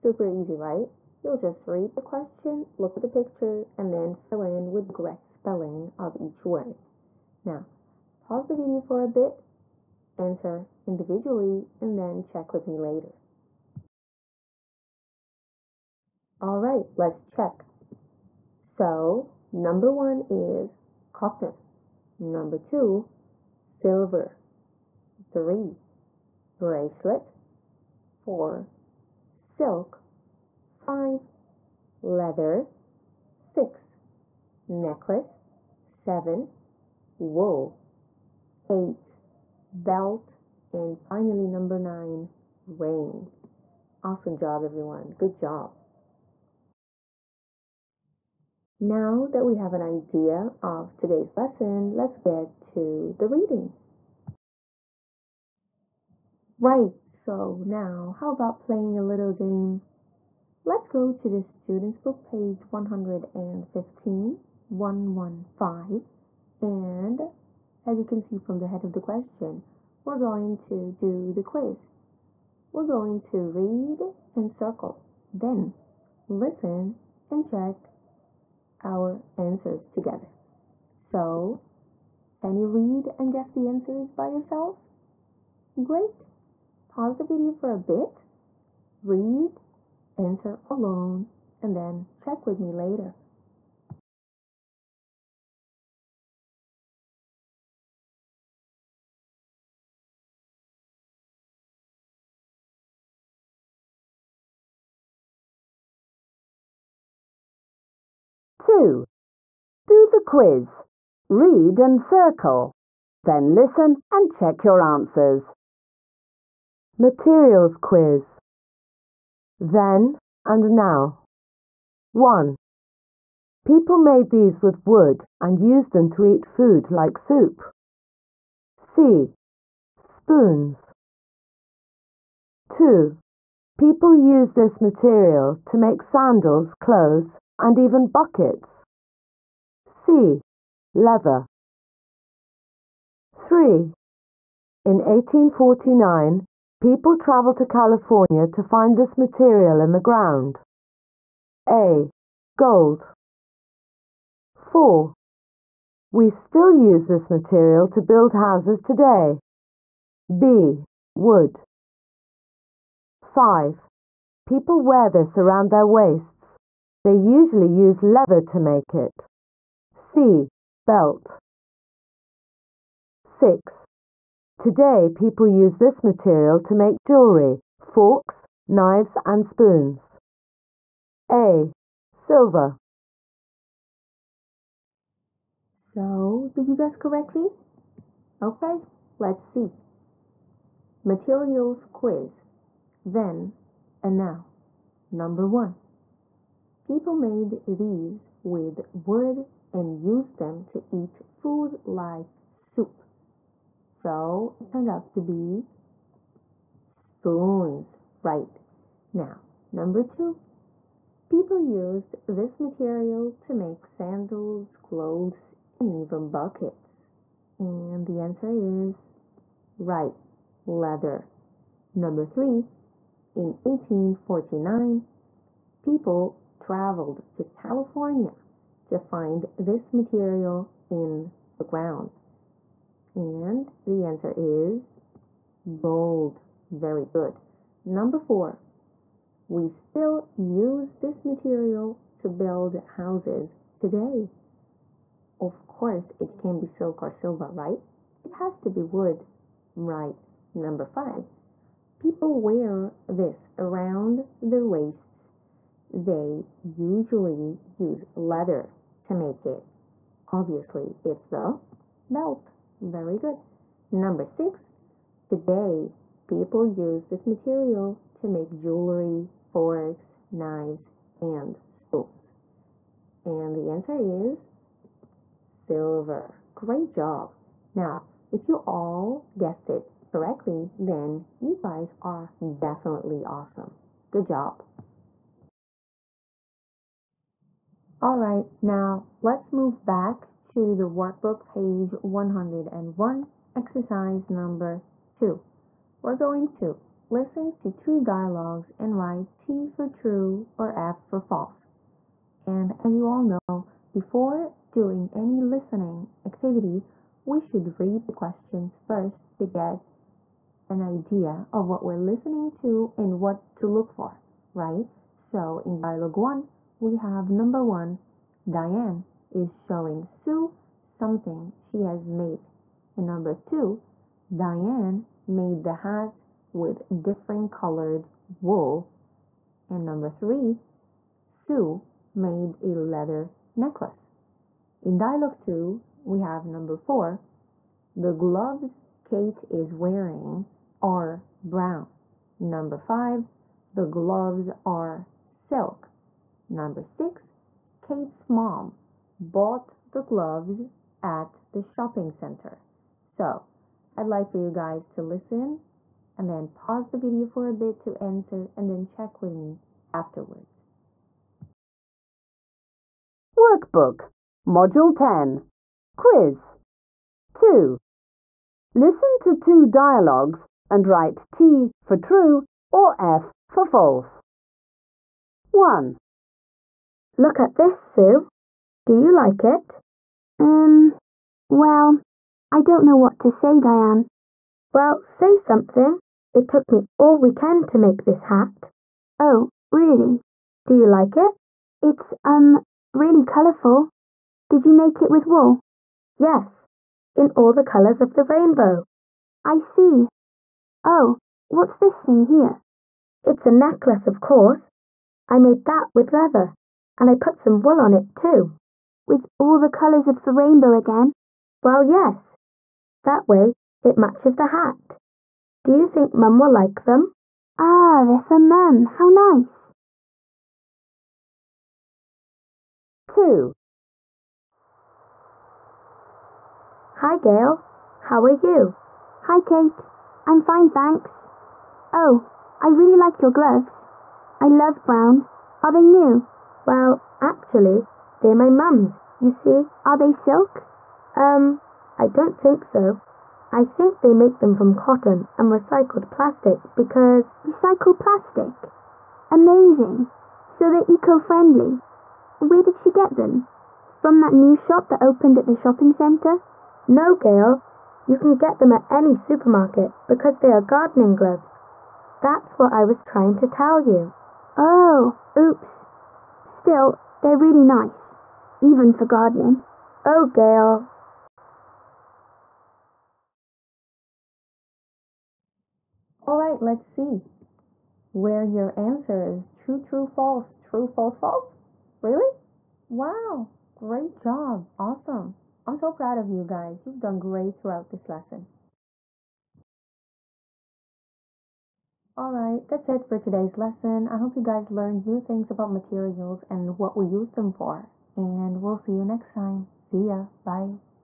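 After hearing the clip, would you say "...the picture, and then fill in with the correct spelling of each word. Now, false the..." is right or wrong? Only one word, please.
wrong.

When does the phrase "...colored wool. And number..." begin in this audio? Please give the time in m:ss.
5:27.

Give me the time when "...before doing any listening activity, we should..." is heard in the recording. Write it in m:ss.
5:03.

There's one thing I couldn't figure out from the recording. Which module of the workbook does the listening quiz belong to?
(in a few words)
Module 10.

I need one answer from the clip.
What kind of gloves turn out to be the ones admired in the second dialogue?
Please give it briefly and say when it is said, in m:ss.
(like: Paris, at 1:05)
Gardening gloves, at 7:40.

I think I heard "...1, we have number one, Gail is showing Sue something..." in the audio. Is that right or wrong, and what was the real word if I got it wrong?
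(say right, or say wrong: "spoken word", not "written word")
wrong: "Diane", not "Gail".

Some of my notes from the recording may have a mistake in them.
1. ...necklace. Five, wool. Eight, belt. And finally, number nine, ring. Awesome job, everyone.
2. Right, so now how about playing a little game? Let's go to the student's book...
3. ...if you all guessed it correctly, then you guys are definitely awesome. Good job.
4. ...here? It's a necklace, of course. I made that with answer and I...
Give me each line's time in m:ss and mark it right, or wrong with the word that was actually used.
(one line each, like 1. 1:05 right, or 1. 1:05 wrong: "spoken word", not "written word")
1. 0:34 wrong: "Seven", not "Five"
2. 0:56 right
3. 4:38 right
4. 6:42 wrong: "leather", not "answer".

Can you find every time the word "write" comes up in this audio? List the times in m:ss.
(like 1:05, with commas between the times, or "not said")
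4:58, 6:10.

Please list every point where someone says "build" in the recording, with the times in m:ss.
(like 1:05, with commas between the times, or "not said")
2:37, 4:02.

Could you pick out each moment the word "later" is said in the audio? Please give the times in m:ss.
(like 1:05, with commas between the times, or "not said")
0:12, 1:32.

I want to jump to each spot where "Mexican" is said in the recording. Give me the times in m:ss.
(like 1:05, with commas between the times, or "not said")
not said.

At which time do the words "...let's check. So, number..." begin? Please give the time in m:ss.
0:16.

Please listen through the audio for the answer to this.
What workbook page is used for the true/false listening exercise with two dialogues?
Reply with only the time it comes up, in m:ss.
4:51.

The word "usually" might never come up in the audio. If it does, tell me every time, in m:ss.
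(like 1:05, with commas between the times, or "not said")
2:47, 4:16.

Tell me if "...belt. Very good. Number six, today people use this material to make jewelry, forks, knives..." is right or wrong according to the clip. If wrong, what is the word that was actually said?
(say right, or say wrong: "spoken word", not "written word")
right.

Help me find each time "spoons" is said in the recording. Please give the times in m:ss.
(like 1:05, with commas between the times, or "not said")
2:09, 2:59, 3:26, 4:31.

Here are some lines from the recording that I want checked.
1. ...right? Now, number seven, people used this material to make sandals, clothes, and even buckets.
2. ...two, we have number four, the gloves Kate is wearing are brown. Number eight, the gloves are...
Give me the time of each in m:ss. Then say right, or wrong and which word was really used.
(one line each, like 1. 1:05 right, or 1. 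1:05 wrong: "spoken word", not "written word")
1. 3:28 wrong: "two", not "seven"
2. 5:35 wrong: "five", not "eight".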